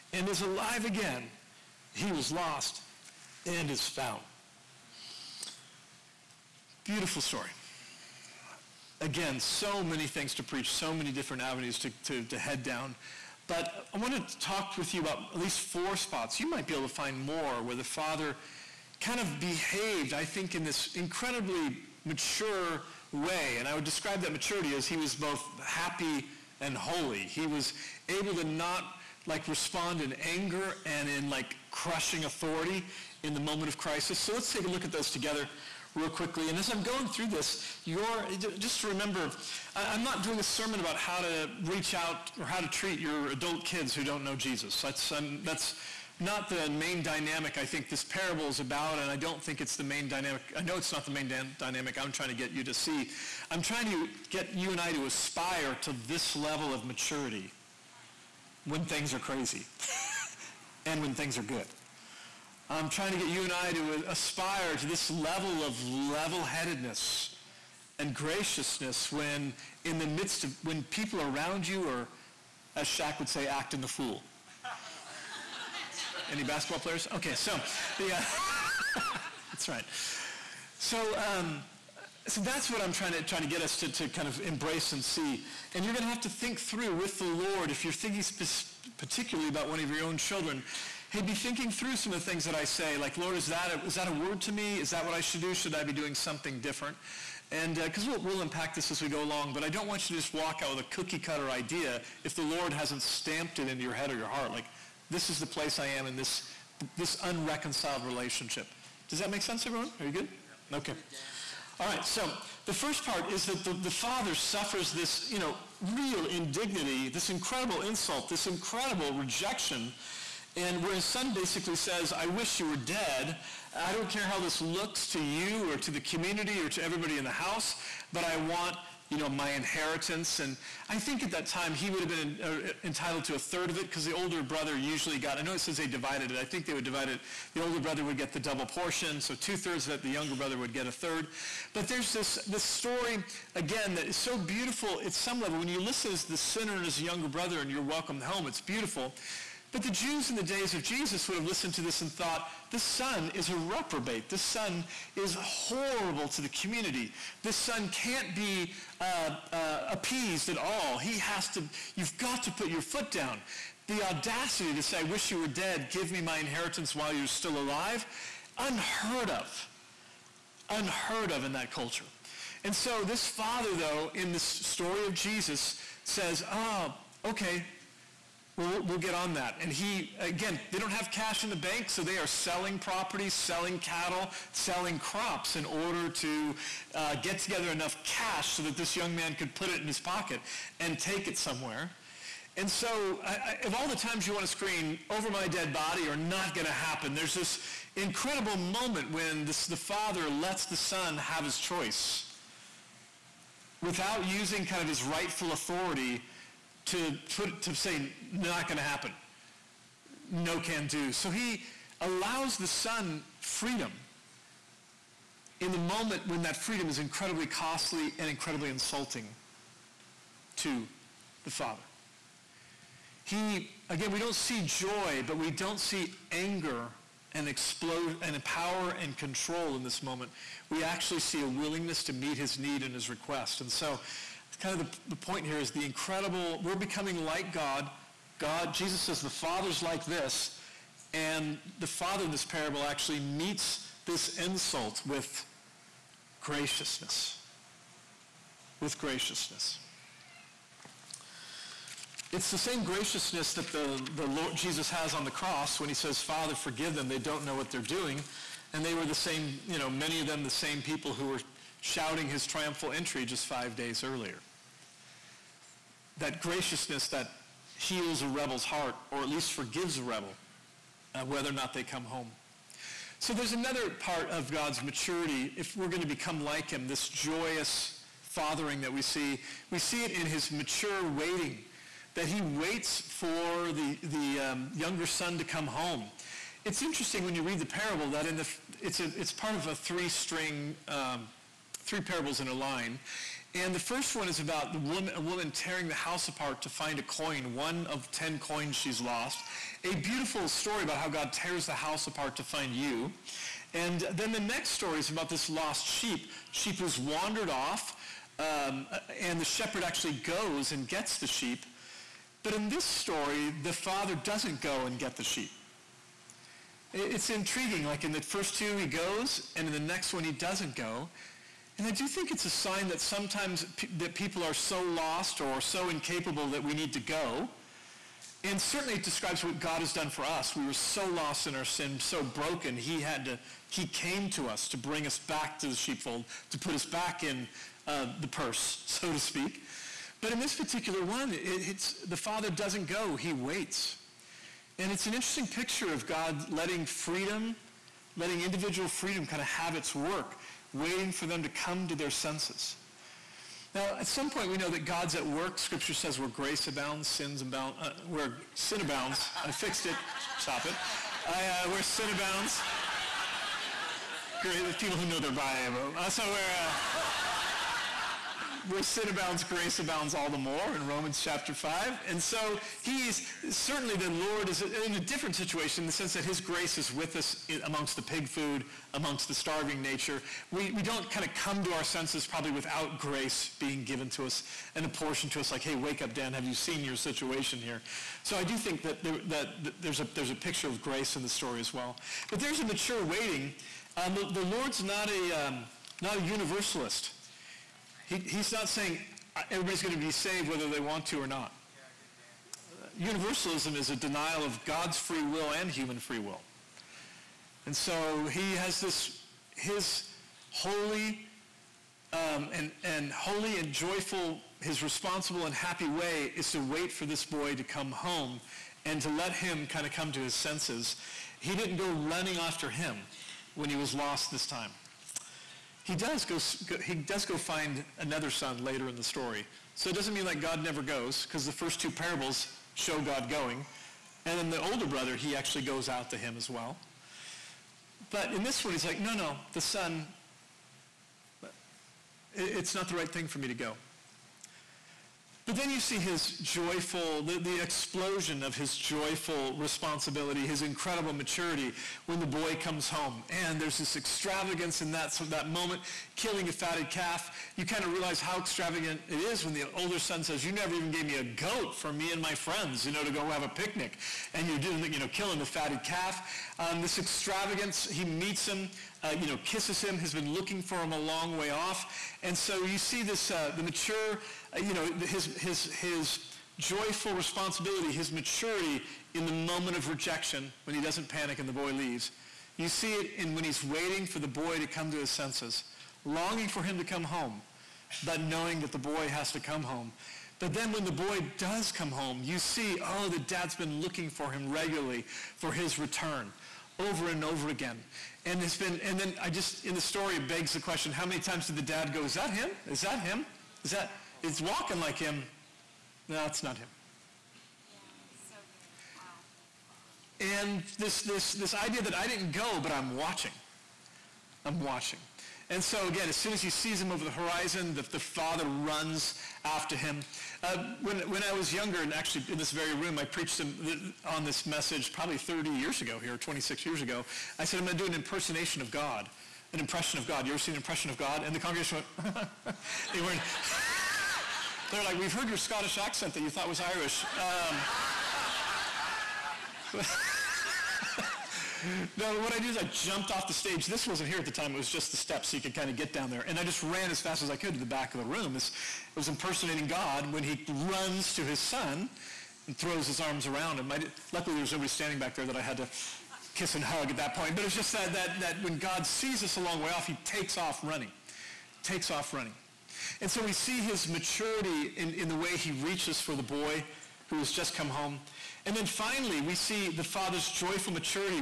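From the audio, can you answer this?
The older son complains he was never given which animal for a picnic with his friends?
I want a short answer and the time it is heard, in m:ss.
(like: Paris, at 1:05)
a goat, at 7:41.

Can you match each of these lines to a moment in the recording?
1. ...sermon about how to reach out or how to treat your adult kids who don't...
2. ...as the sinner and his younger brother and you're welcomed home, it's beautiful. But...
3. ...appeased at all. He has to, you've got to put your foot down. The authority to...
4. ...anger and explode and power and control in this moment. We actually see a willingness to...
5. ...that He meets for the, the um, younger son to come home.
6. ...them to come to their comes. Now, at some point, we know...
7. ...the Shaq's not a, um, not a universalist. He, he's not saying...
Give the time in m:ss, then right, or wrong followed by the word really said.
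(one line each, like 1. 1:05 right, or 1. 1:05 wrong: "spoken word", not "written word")
1. 0:40 right
2. 2:26 right
3. 2:39 wrong: "audacity", not "authority"
4. 3:46 right
5. 4:42 wrong: "waits", not "meets"
6. 5:51 wrong: "senses", not "comes"
7. 6:34 wrong: "Lord", not "Shaq".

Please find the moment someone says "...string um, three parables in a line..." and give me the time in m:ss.
4:50.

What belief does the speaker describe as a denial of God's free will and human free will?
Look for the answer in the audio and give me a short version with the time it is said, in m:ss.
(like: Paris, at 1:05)
Universalism, at 6:42.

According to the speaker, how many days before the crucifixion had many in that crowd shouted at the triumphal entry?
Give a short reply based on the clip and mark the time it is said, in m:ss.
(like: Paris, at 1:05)
5, at 4:23.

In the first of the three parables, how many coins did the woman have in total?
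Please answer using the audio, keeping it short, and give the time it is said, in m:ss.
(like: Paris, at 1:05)
10, at 4:58.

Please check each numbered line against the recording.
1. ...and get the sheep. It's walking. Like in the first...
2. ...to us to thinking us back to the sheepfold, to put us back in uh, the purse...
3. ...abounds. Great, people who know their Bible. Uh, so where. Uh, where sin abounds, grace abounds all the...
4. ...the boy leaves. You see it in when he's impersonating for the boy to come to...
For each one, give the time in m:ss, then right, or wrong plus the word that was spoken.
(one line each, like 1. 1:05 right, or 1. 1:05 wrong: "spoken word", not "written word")
1. 5:14 wrong: "intriguing", not "walking"
2. 5:34 wrong: "bring", not "thinking"
3. 6:02 right
4. 8:01 wrong: "waiting", not "impersonating".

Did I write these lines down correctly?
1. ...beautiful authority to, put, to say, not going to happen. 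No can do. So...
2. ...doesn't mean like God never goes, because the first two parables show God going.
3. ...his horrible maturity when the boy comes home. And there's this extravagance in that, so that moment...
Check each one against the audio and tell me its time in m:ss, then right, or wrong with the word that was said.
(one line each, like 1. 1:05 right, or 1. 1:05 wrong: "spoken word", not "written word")
1. 3:25 wrong: "rightful", not "beautiful"
2. 7:09 right
3. 7:30 wrong: "incredible", not "horrible".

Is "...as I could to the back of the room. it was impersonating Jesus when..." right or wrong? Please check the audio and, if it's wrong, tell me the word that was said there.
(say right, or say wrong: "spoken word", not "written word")
wrong: "God", not "Jesus".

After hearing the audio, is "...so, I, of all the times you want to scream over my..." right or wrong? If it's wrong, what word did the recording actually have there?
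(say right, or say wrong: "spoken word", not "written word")
right.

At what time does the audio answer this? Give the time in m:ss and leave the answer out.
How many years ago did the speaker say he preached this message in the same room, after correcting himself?
8:46.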